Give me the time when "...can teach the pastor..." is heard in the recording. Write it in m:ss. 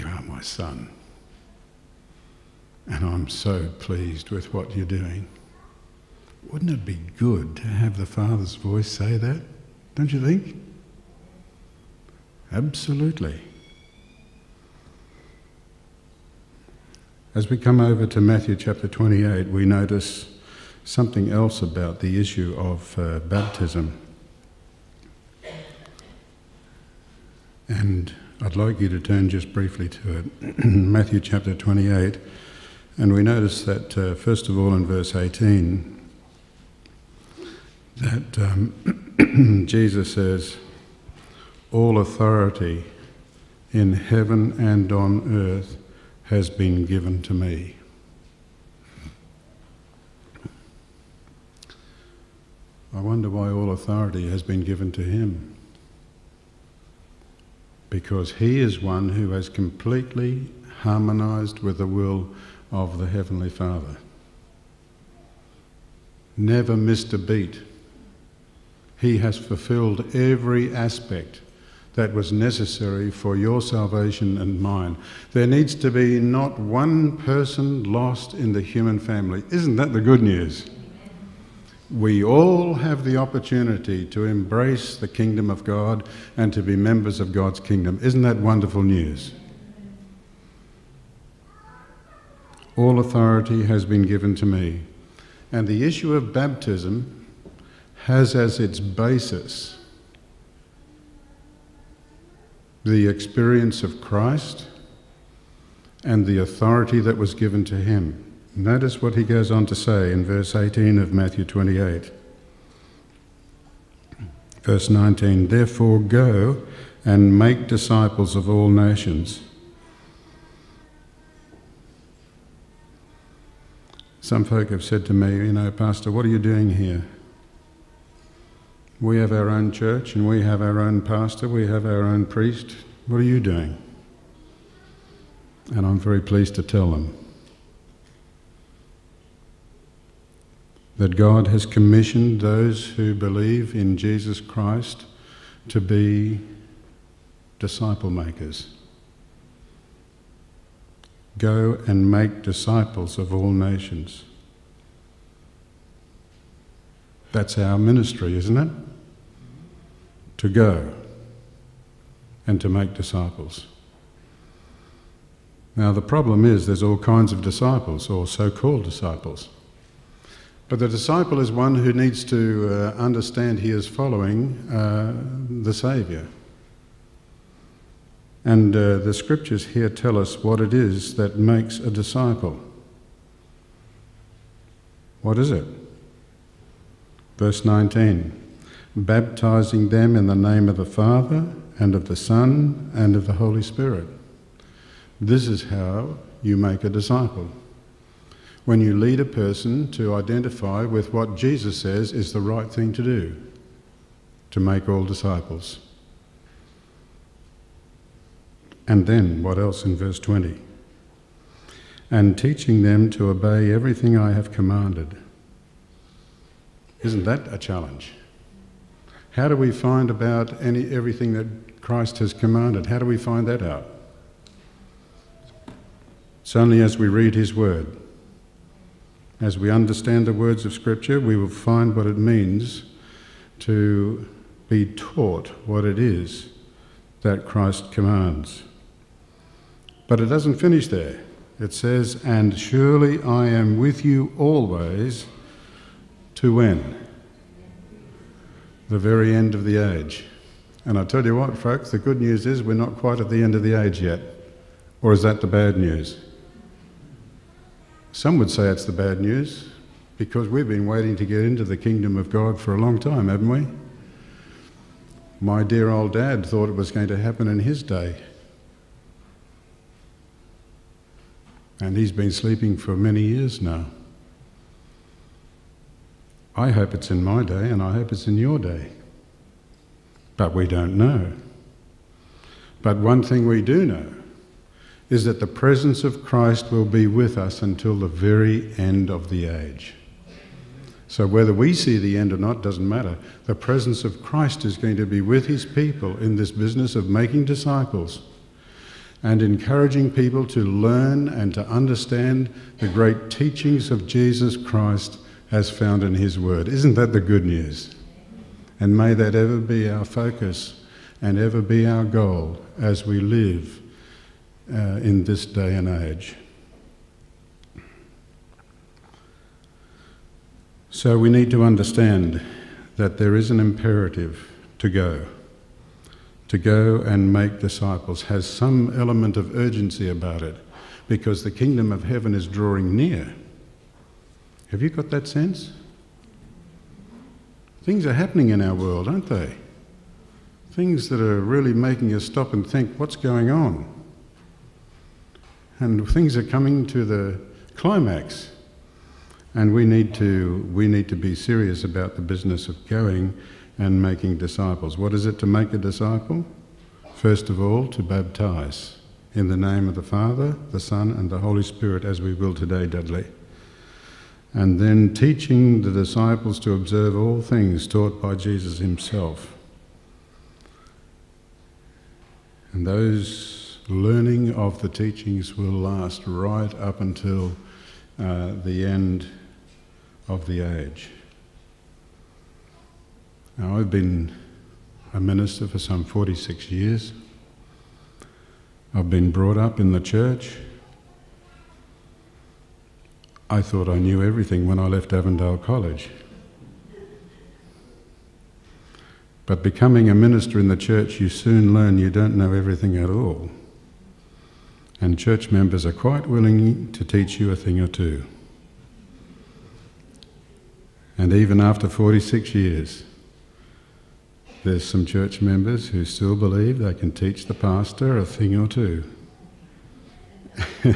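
6:56.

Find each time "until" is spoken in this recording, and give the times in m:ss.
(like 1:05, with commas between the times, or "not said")
4:47, 6:16.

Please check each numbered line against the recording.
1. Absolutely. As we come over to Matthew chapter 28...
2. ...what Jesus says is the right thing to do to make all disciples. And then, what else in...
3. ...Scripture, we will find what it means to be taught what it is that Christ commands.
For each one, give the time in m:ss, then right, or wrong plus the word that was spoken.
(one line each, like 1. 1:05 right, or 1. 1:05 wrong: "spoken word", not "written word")
1. 0:12 right
2. 3:21 right
3. 3:50 right.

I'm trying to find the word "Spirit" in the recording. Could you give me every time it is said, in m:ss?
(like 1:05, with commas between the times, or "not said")
3:13, 6:01.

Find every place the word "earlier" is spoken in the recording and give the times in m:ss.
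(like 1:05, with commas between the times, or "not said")
not said.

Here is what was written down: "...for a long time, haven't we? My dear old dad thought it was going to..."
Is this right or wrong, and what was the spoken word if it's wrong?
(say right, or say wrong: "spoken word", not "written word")
right.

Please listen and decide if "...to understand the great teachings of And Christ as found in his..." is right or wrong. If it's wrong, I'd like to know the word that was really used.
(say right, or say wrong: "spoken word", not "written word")
wrong: "Jesus", not "And".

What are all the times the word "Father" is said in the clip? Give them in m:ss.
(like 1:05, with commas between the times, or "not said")
0:08, 1:03, 3:10, 6:00.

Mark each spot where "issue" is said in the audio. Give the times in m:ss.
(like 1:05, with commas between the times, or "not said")
0:22, 1:35.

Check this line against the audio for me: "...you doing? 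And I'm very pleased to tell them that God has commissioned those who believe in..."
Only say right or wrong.
right.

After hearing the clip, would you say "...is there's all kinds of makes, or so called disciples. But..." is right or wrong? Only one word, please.
wrong.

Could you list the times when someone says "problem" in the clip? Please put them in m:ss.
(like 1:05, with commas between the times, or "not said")
2:46.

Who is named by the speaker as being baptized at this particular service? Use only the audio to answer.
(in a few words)
Dudley.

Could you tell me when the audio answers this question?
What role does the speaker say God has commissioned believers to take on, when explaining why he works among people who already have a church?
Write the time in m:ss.
2:27.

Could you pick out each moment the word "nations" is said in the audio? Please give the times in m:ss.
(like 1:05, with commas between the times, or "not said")
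1:58, 2:33.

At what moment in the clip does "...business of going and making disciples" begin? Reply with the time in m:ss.
5:52.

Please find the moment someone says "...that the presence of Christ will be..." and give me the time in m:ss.
4:45.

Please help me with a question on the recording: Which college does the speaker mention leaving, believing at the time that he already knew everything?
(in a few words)
Avondale College.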